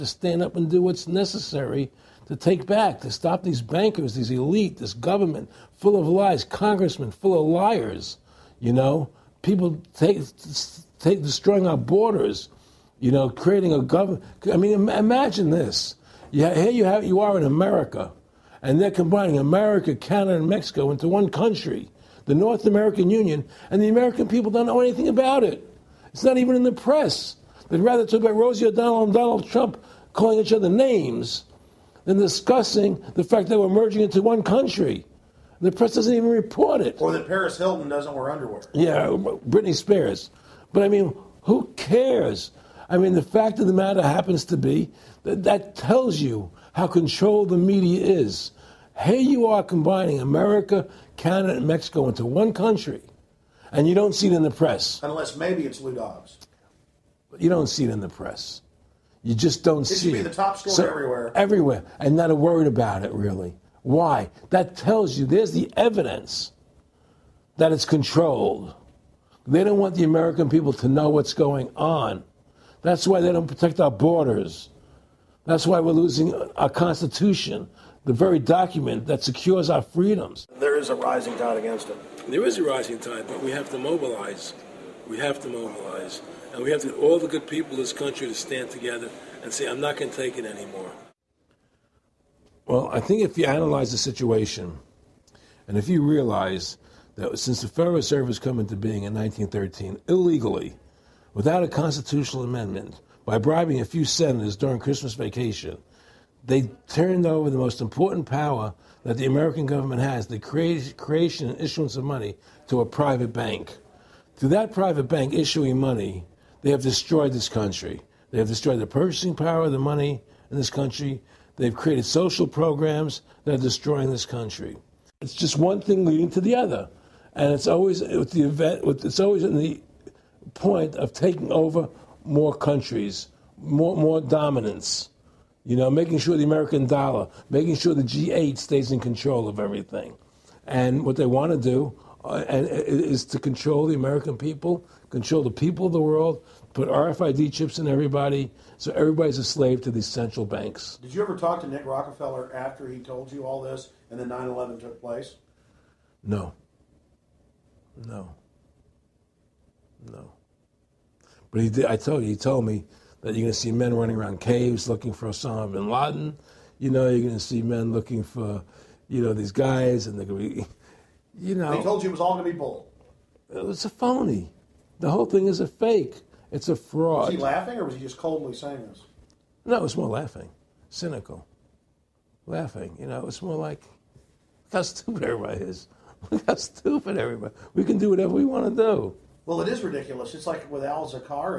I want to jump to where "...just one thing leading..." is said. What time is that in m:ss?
2:05.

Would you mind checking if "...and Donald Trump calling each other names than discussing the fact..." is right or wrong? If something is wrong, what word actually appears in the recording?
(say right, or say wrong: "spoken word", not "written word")
right.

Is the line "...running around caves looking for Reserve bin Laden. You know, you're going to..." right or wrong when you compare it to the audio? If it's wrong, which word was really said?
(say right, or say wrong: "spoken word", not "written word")
wrong: "Osama", not "Reserve".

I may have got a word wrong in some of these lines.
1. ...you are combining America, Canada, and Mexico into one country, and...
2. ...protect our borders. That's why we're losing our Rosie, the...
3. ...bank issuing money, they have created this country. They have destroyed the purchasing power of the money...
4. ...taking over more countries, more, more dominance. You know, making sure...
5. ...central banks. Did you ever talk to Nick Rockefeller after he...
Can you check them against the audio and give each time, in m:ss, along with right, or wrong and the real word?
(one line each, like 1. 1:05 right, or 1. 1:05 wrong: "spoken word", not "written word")
1. 0:49 right
2. 1:13 wrong: "Constitution", not "Rosie"
3. 1:55 wrong: "destroyed", not "created"
4. 2:11 right
5. 2:30 right.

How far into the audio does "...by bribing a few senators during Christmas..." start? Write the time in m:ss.
1:43.